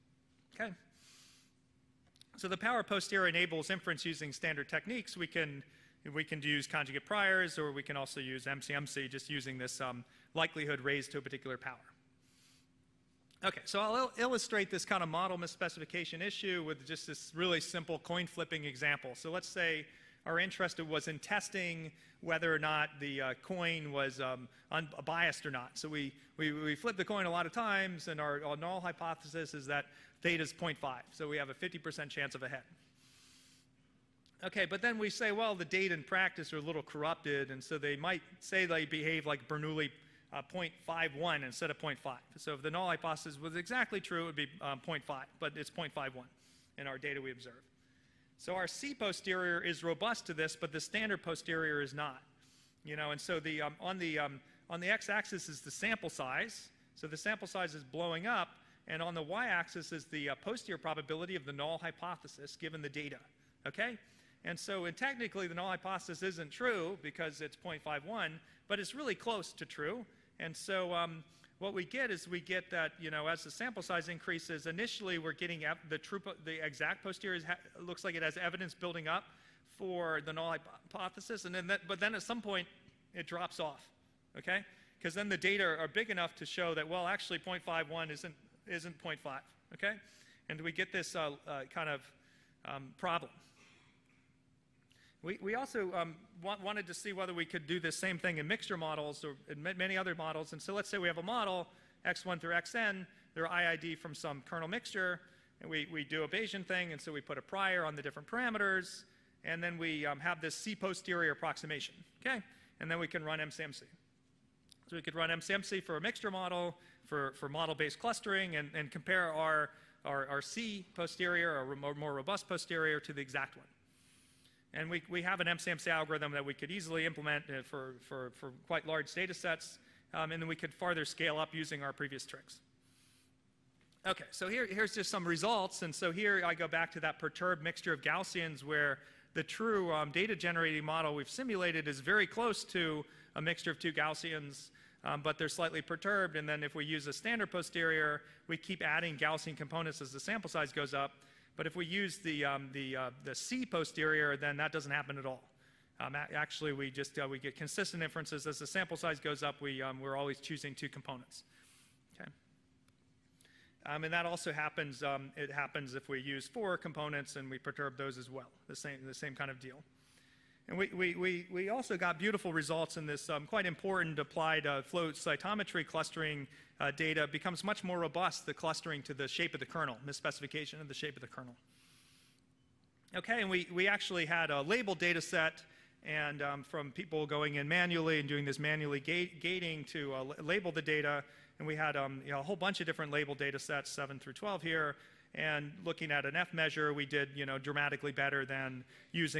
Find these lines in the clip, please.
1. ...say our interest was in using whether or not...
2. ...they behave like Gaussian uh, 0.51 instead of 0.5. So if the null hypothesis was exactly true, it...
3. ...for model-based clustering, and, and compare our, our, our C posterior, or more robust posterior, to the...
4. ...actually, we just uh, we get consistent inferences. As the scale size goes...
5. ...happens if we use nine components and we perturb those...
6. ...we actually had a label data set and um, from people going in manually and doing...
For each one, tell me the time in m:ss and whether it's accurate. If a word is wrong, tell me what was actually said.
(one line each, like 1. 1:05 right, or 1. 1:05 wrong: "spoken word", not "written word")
1. 0:19 wrong: "testing", not "using"
2. 0:38 wrong: "Bernoulli", not "Gaussian"
3. 1:57 right
4. 2:36 wrong: "sample", not "scale"
5. 2:45 wrong: "four", not "nine"
6. 3:03 right.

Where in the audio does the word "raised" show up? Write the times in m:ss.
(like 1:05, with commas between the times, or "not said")
0:10.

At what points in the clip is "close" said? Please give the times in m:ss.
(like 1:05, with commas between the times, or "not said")
1:09, 2:22.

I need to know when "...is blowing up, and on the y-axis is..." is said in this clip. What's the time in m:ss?
0:57.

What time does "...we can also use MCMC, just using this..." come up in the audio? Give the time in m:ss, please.
0:07.